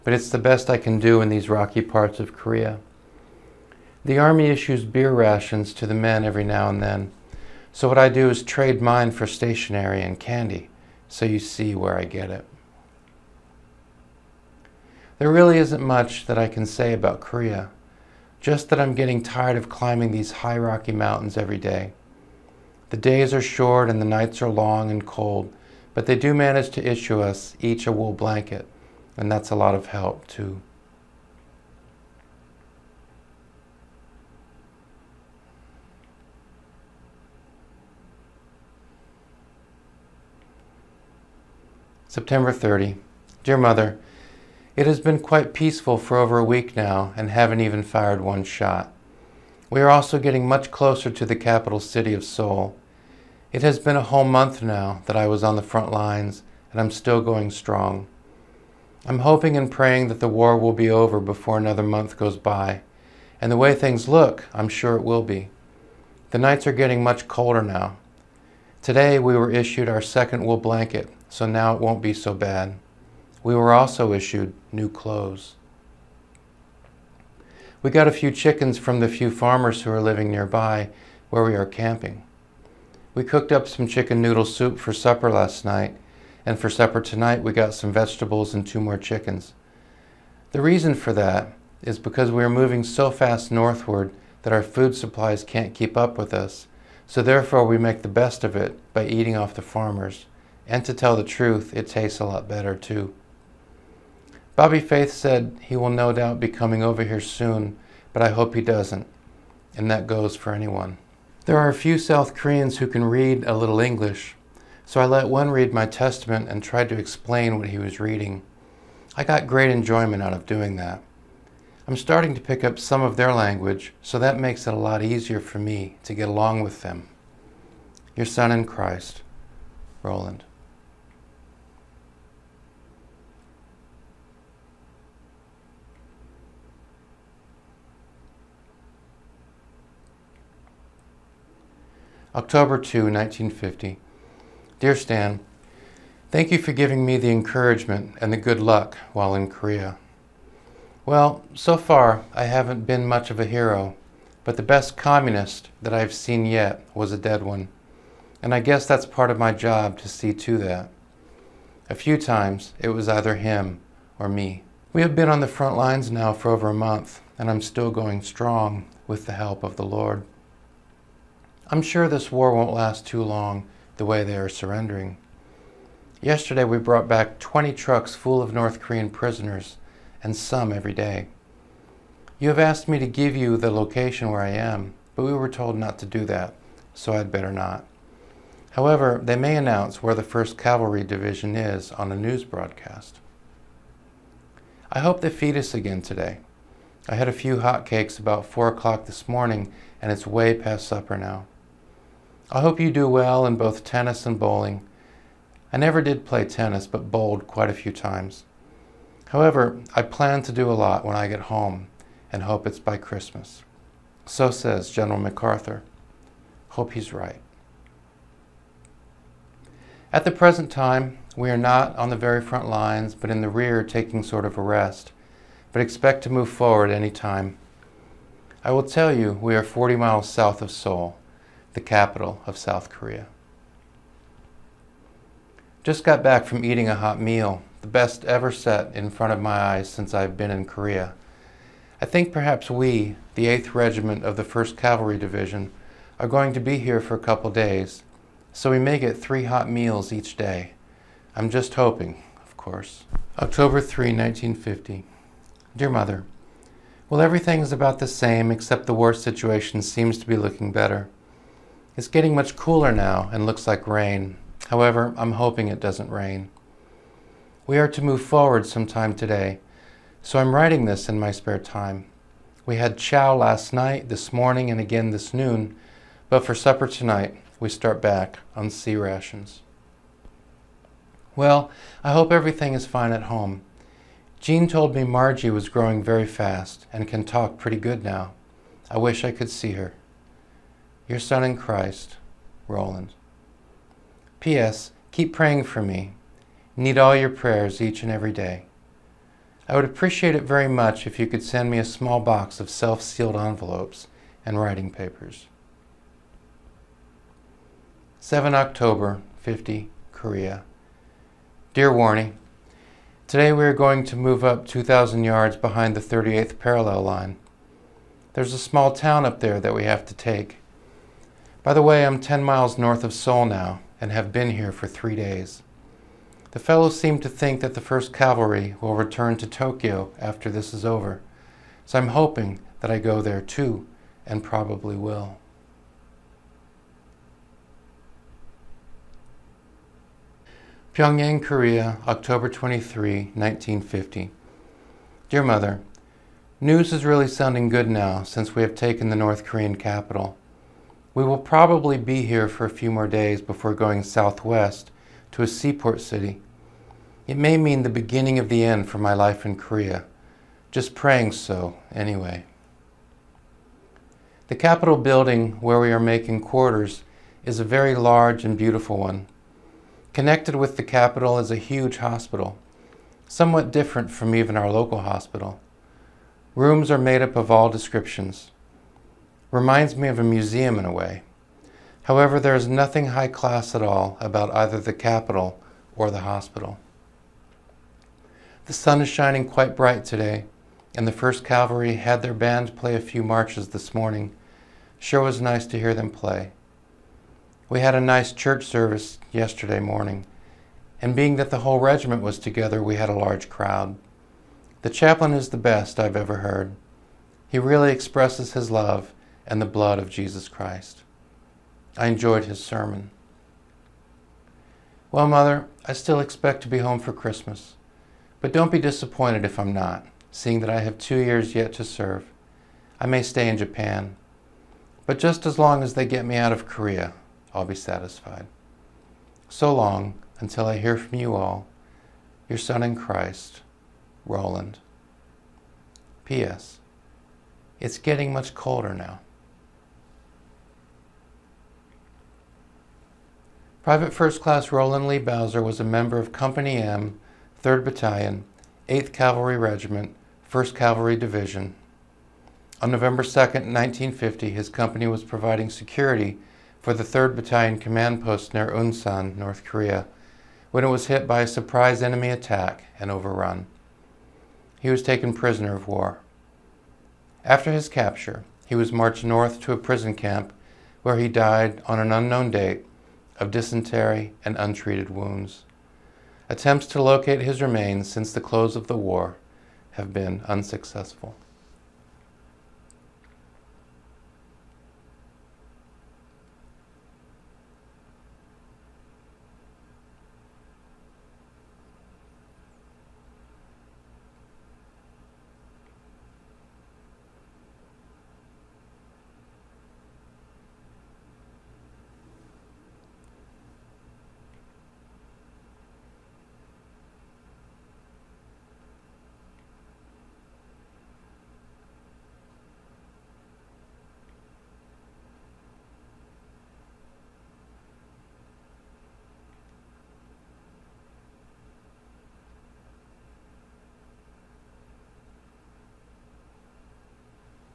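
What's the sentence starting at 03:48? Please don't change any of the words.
I will tell you, we are 40 miles south of Seoul the capital of South Korea.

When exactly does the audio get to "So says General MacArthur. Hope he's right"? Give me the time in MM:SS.
03:34.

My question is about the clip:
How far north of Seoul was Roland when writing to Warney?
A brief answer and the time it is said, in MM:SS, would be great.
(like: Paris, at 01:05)
10 miles, at 05:22.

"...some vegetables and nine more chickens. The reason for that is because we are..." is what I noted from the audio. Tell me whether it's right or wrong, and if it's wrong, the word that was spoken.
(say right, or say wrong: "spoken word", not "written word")
wrong: "two", not "nine".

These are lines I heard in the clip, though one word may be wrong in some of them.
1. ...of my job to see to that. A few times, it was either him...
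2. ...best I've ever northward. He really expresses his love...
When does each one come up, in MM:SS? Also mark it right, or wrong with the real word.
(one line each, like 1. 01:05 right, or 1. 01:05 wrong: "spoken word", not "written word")
1. 02:39 right
2. 06:45 wrong: "heard", not "northward".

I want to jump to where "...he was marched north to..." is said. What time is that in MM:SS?
07:48.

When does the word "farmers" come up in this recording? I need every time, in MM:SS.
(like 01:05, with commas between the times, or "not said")
01:19, 01:39.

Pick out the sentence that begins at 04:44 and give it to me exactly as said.
Jean told me Marjie was growing very fast and can talk pretty good now.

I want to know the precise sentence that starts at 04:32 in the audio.
We had chow last night, this morning, and again this noon, but for supper tonight, we start back on C rations.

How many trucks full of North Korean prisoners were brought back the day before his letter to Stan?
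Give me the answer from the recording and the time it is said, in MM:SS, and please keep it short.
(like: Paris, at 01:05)
20, at 02:57.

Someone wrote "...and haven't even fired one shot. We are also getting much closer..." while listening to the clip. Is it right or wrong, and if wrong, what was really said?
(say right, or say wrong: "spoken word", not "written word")
right.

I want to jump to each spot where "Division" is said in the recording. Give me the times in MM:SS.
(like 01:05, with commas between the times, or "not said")
03:11, 04:05, 07:31.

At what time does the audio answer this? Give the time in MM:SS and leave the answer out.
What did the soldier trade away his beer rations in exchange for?
00:09.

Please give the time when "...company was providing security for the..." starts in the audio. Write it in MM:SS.
07:34.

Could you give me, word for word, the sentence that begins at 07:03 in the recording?
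I may stay in Japan, but just as long as they get me out of Korea, I'll be satisfied.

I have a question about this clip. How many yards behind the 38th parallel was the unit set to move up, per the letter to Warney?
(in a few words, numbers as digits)
2,000 yards.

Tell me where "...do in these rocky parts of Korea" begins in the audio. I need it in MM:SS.
00:00.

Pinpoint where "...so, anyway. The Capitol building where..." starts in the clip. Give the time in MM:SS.
06:01.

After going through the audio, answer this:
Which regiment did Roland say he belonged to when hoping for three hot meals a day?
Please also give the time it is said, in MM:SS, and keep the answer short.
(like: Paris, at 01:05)
8th Regiment, at 04:03.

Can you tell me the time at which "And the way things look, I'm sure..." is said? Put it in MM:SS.
01:03.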